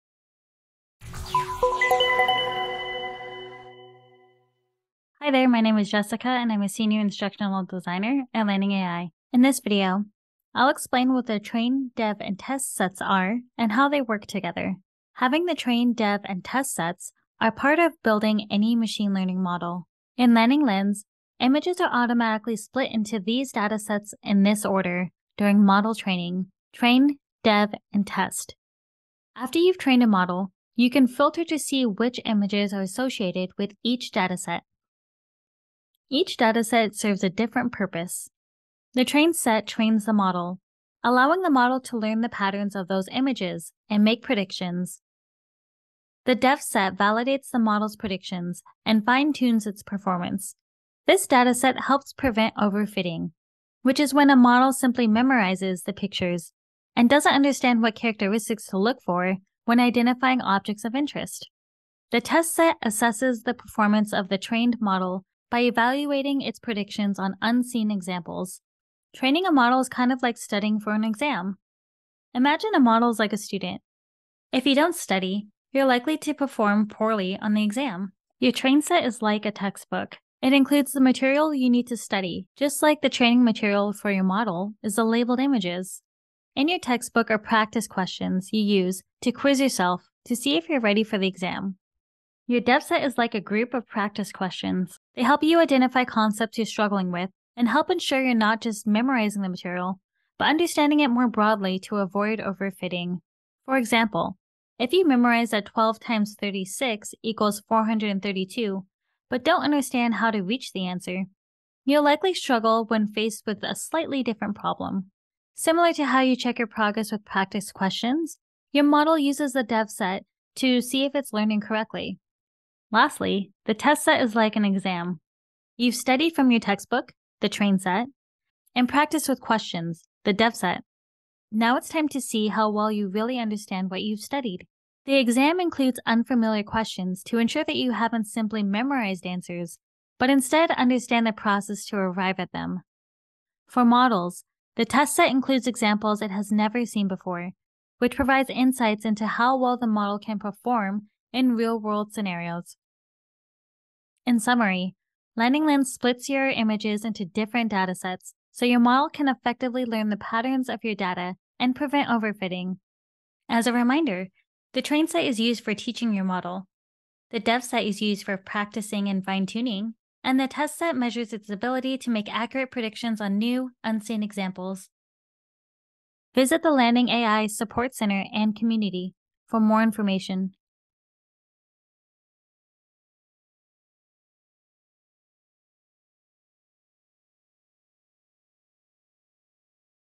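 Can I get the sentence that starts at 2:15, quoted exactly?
The exam includes unfamiliar questions to ensure that you haven't simply memorized answers, but instead understand the process to arrive at them.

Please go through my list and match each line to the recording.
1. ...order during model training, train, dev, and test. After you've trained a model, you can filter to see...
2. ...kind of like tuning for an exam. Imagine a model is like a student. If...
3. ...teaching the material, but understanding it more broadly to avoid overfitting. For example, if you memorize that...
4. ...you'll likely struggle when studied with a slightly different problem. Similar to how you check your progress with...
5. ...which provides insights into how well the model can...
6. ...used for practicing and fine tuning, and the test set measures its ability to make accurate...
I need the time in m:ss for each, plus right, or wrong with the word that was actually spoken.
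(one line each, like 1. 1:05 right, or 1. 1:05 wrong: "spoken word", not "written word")
1. 0:24 right
2. 1:09 wrong: "studying", not "tuning"
3. 1:38 wrong: "memorizing", not "teaching"
4. 1:51 wrong: "faced", not "studied"
5. 2:27 right
6. 2:48 right.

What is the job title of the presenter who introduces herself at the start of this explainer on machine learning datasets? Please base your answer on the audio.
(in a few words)
Senior Instructional Designer.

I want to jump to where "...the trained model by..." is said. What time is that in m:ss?
1:04.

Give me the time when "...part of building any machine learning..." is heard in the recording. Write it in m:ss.
0:17.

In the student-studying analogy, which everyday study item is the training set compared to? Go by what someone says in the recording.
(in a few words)
A textbook.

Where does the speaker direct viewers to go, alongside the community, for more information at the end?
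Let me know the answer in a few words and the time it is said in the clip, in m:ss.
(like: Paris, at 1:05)
Landing AI Support Center, at 2:56.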